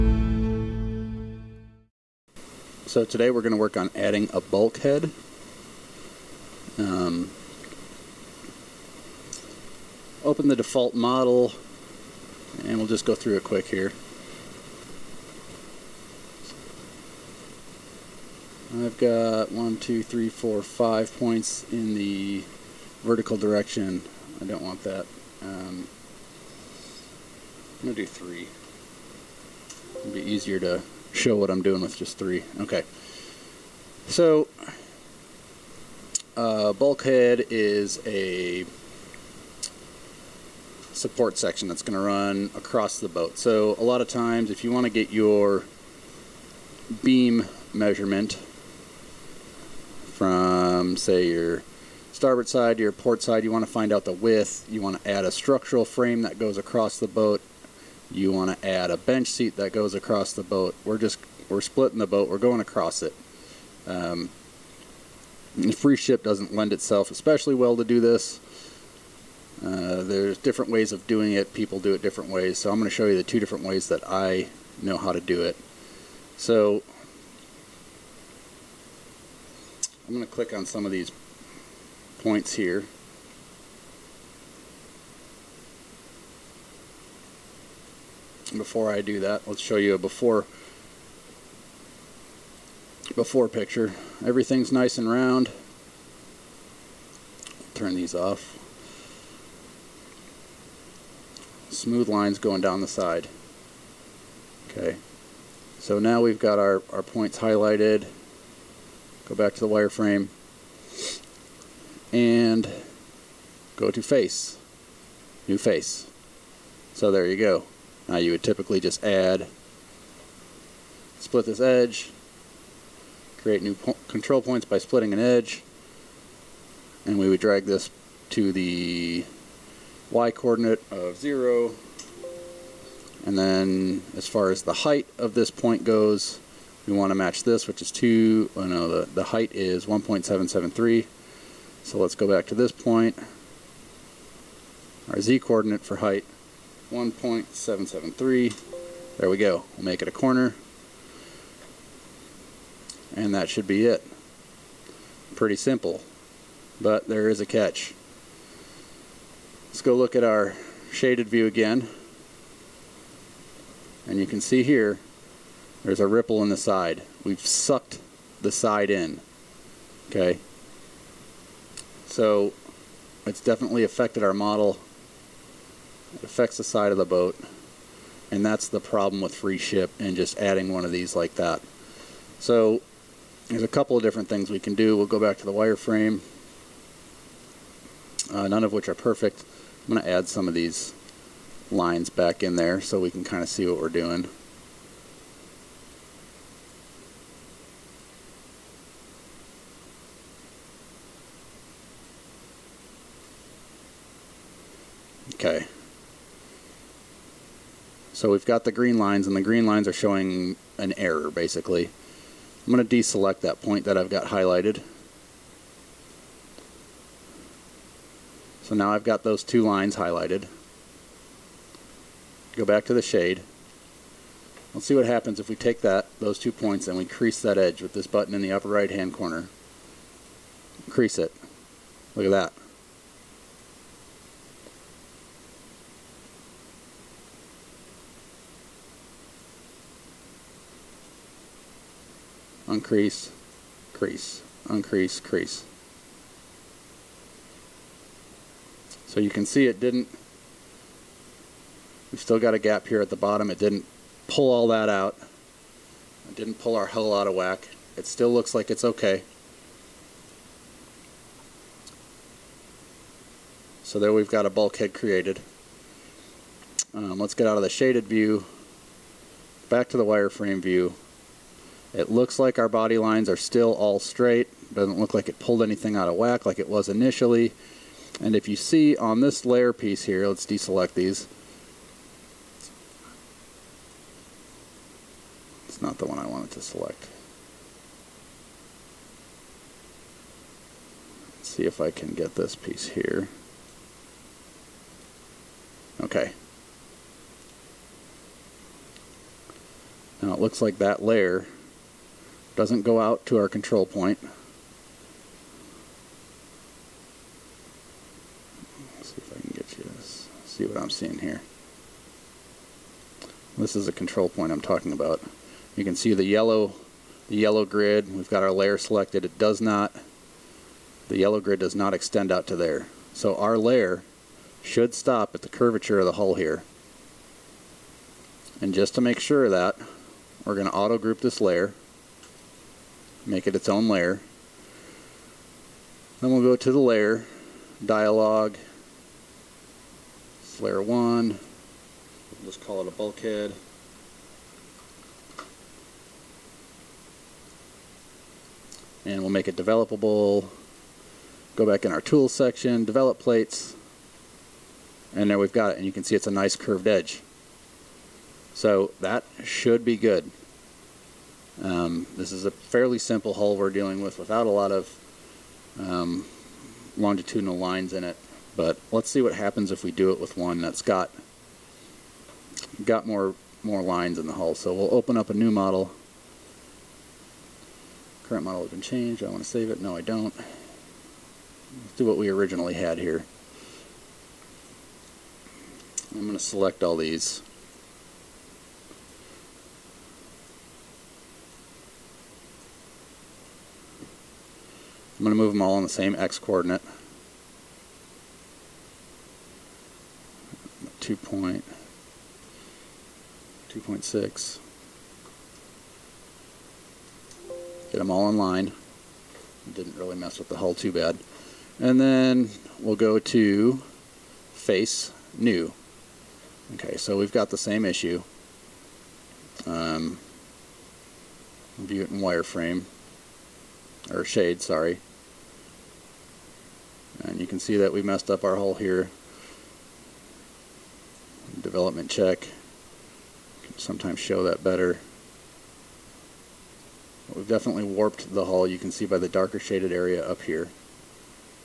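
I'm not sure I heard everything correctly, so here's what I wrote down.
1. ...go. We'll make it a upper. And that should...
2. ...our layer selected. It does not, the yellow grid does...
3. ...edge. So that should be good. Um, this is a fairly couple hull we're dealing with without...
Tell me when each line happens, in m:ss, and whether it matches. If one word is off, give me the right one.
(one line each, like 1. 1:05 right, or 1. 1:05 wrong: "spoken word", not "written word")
1. 2:29 wrong: "corner", not "upper"
2. 5:18 right
3. 5:56 wrong: "simple", not "couple".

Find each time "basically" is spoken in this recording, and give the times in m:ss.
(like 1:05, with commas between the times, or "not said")
3:31.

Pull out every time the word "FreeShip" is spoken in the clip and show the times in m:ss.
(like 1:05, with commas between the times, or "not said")
1:05, 2:59.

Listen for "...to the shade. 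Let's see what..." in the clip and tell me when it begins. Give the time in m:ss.
3:42.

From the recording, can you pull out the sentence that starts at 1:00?
We're just we're splitting the boat.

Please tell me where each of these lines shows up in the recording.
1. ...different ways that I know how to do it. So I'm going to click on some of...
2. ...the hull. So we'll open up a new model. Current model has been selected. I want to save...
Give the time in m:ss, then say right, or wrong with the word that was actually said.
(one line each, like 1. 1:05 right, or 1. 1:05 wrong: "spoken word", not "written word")
1. 1:13 right
2. 6:14 wrong: "changed", not "selected".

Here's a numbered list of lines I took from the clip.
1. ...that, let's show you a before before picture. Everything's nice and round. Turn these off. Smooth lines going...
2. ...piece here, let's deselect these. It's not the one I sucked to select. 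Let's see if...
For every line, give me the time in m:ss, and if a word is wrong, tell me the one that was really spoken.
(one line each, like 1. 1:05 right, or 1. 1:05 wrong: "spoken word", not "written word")
1. 1:29 right
2. 4:39 wrong: "wanted", not "sucked".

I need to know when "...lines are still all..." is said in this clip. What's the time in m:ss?
4:32.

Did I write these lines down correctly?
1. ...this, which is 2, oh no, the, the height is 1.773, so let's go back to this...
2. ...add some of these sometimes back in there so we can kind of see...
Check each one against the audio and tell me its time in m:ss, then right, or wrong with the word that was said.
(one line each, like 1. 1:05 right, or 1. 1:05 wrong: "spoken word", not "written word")
1. 2:17 right
2. 3:10 wrong: "lines", not "sometimes".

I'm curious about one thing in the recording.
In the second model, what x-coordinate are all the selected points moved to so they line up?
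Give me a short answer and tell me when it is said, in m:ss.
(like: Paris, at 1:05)
2.6, at 6:43.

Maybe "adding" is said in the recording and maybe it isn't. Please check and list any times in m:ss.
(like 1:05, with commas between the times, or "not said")
0:03, 3:00.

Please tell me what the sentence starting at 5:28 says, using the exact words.
And just to make sure of that, we're going to auto group this layer make it its own layer.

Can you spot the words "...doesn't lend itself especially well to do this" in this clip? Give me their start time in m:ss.
1:06.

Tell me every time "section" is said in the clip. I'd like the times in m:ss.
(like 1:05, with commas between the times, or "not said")
0:41, 5:52.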